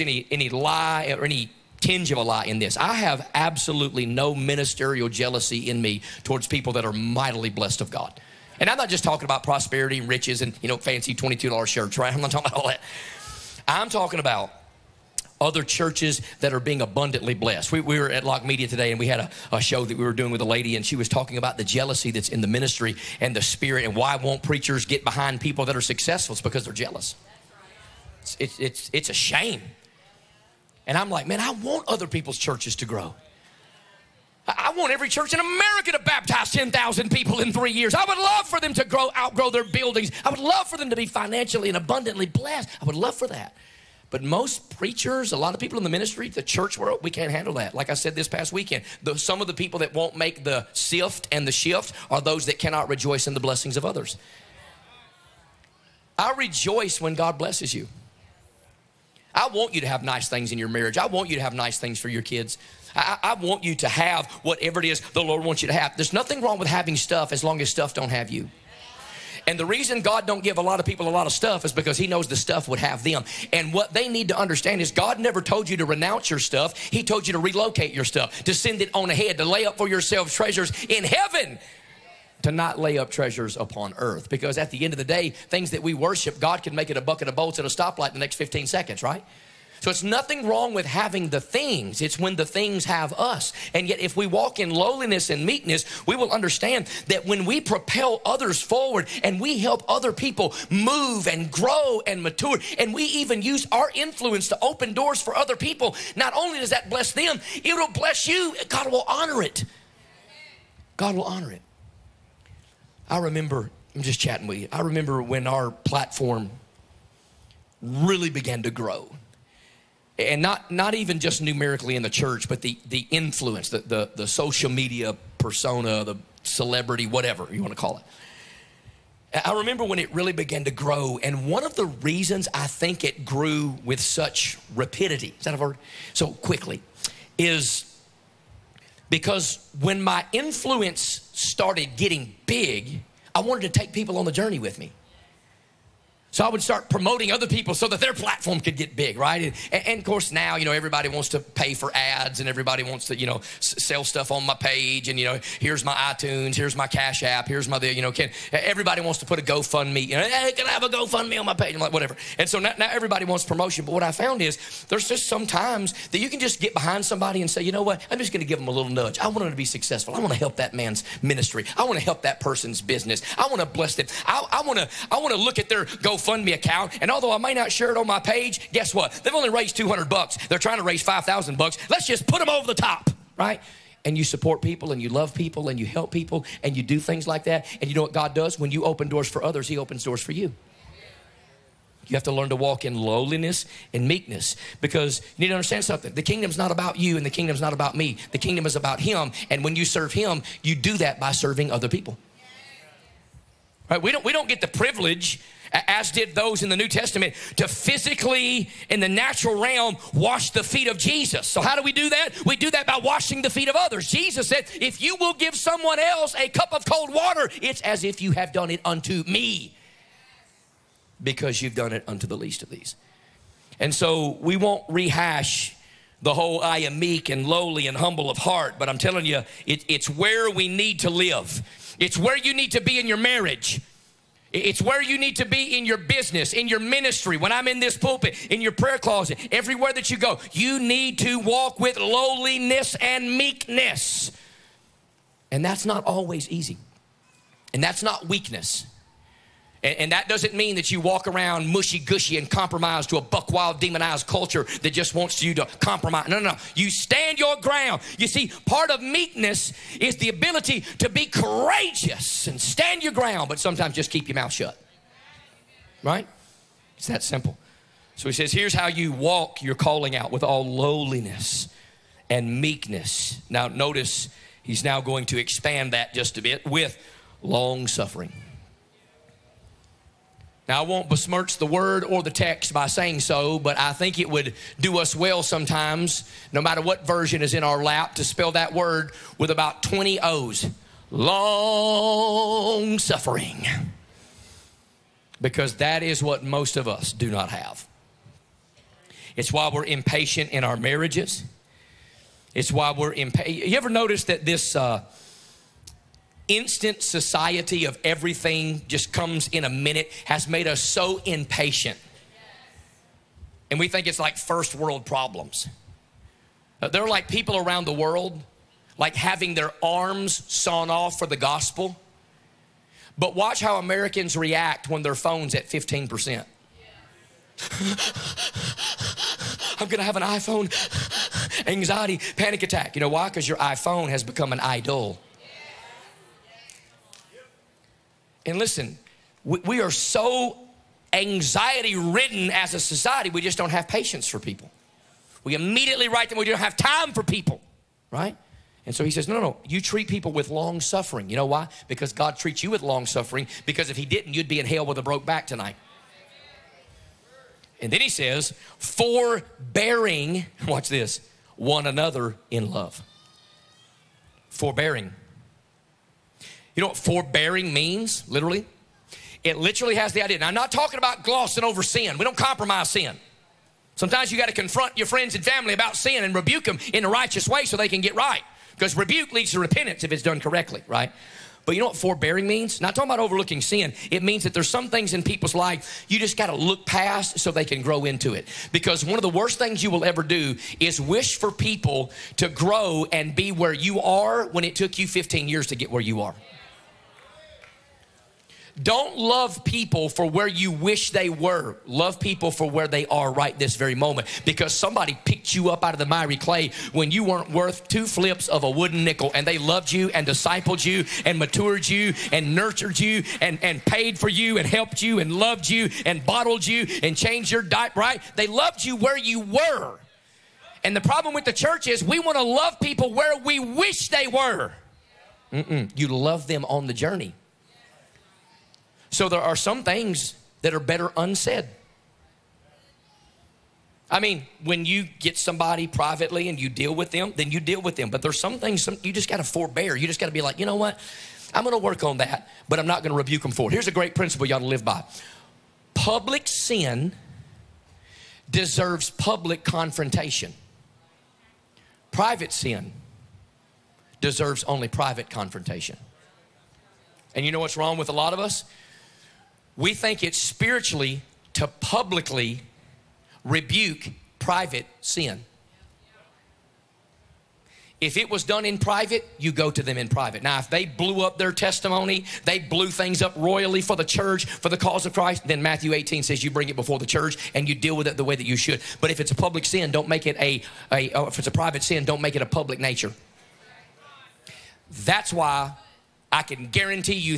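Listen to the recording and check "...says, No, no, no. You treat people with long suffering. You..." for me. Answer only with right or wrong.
right.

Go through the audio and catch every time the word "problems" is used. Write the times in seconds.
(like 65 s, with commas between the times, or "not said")
315 s, 421 s.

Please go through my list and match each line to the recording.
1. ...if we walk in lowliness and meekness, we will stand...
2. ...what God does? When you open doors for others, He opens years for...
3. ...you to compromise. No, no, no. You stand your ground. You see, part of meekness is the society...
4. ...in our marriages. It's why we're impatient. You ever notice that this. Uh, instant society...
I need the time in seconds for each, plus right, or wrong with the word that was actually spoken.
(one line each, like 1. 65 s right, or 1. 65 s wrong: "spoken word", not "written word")
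1. 93 s wrong: "understand", not "stand"
2. 188 s wrong: "doors", not "years"
3. 255 s wrong: "ability", not "society"
4. 300 s right.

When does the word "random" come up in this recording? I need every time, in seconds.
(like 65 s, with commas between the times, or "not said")
not said.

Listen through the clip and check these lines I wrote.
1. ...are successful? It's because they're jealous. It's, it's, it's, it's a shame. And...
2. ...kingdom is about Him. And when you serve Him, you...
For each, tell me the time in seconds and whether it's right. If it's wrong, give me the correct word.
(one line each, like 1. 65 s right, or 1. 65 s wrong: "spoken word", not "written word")
1. 25 s right
2. 198 s right.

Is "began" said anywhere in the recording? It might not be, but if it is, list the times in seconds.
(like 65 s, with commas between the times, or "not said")
118 s, 130 s.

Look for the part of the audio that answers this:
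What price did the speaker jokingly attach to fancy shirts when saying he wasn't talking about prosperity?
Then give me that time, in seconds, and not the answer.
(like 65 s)
11 s.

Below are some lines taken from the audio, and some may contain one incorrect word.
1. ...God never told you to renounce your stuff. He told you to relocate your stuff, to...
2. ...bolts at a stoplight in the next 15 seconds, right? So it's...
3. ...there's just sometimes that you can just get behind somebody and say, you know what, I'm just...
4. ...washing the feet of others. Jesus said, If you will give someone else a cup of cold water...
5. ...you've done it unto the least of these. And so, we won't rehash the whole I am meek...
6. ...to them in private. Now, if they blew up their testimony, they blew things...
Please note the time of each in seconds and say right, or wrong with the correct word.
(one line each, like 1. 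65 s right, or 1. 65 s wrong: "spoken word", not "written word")
1. 74 s right
2. 87 s right
3. 164 s right
4. 212 s right
5. 221 s right
6. 469 s right.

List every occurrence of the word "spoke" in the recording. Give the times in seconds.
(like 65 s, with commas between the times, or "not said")
not said.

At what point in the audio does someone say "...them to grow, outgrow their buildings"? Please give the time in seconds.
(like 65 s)
38 s.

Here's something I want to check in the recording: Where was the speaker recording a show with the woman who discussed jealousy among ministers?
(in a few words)
Locke Media.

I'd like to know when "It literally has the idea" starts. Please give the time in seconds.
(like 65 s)
369 s.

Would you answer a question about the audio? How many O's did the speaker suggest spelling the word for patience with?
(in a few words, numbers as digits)
20.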